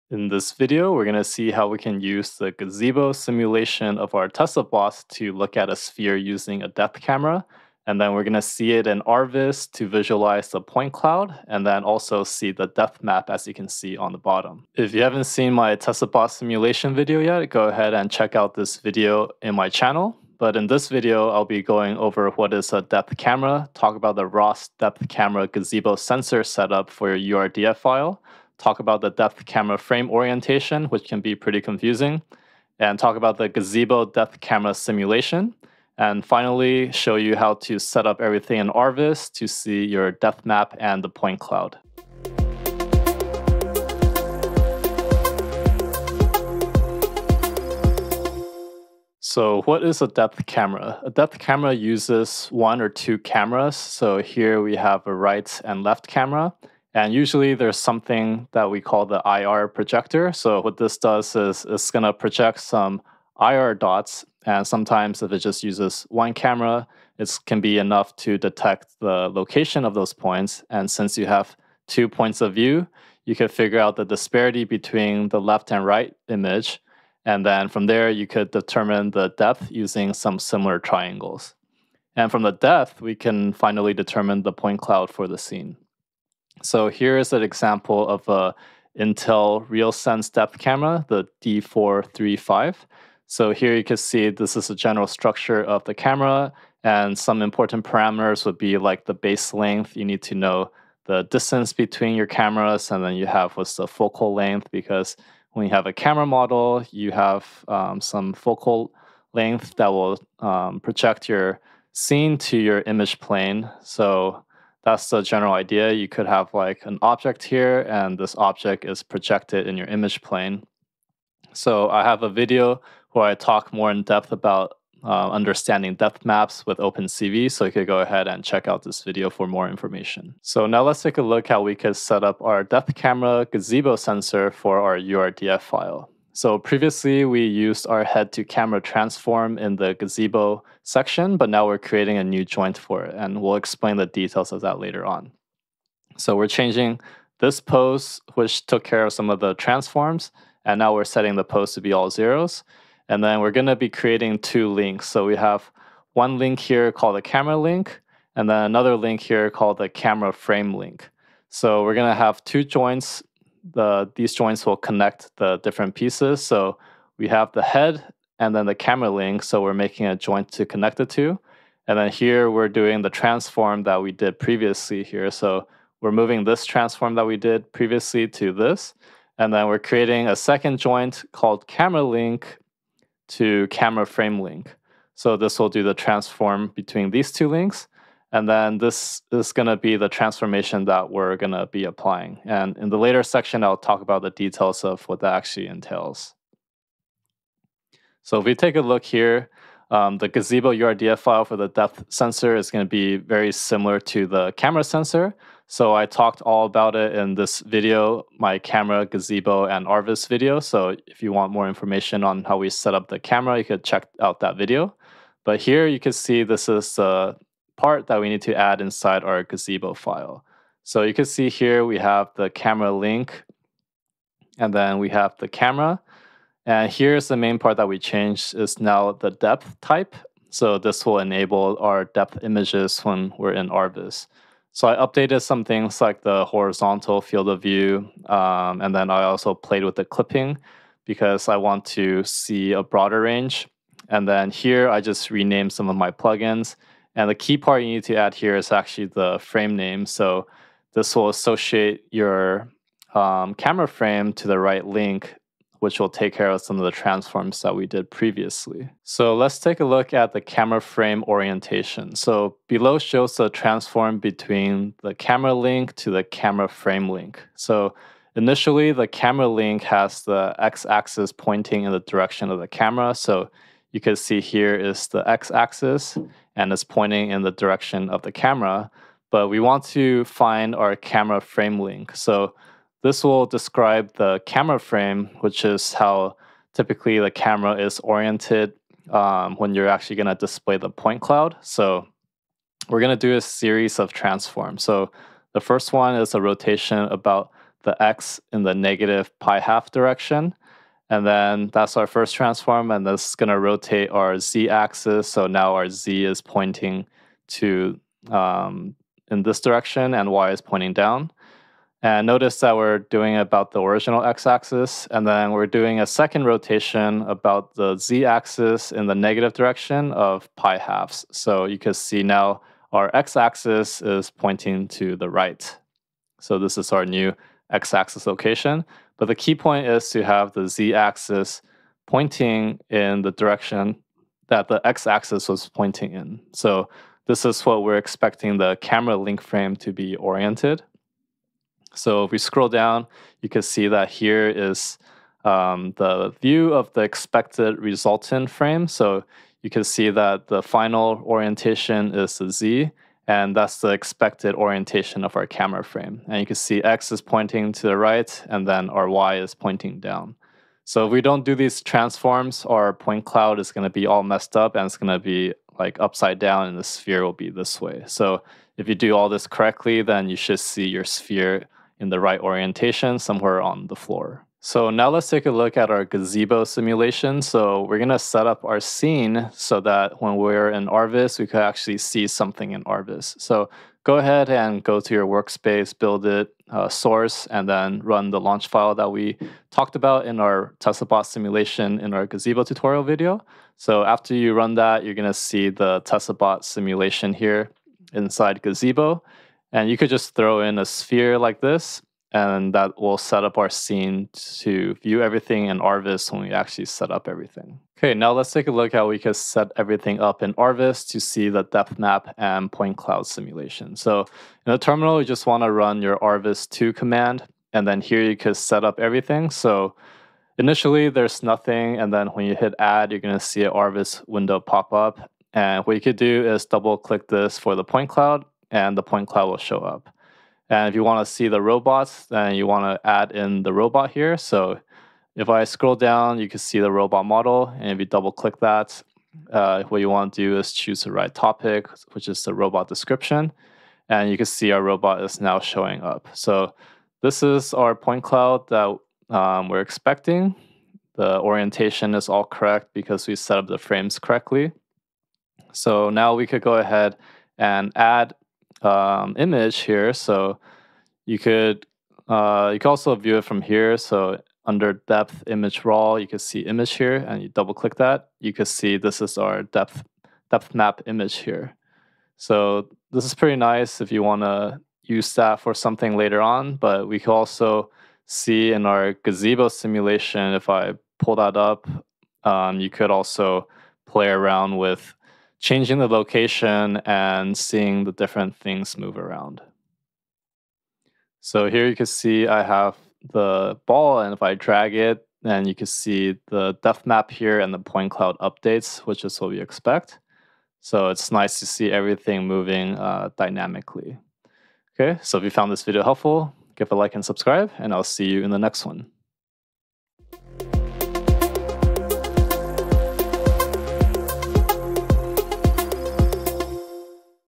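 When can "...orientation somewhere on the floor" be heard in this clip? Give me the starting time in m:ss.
6:12.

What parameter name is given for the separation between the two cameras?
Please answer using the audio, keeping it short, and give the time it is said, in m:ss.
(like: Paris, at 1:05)
base length, at 1:39.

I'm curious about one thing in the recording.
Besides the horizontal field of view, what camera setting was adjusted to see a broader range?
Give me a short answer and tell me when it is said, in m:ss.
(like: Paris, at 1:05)
clipping, at 4:00.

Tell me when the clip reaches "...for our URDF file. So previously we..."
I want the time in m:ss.
2:14.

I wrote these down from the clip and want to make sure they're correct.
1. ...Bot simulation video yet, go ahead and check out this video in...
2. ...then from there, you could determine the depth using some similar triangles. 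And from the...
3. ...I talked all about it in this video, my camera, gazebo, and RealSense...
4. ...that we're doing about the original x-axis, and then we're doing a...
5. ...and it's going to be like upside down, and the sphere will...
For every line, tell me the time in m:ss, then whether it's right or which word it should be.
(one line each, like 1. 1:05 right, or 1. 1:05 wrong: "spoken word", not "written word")
1. 0:16 right
2. 1:17 right
3. 3:25 wrong: "Rviz", not "RealSense"
4. 5:12 right
5. 6:04 right.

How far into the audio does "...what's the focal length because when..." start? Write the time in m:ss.
1:43.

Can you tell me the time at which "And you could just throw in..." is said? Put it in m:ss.
6:39.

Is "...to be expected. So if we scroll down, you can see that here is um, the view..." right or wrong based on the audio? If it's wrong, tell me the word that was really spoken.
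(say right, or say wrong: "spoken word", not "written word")
wrong: "oriented", not "expected".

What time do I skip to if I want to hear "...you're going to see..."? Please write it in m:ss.
7:03.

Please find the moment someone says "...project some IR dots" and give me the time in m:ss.
1:02.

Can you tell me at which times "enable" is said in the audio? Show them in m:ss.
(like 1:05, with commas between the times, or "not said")
3:51.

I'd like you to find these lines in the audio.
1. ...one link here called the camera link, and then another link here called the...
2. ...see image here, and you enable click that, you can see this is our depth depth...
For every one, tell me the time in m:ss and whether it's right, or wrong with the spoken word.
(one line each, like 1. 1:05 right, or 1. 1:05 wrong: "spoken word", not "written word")
1. 2:36 right
2. 7:46 wrong: "double", not "enable".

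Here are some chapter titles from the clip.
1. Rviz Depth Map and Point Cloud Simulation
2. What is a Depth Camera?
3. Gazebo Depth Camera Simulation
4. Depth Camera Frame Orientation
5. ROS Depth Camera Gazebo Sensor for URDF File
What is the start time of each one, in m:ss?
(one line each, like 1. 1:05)
1. 6:47
2. 0:49
3. 6:14
4. 4:18
5. 2:10.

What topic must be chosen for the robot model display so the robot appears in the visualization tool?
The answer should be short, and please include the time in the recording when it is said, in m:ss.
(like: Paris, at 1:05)
robot description, at 7:22.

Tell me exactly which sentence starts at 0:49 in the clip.
So what is a depth camera?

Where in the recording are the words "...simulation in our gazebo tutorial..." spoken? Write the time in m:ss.
6:31.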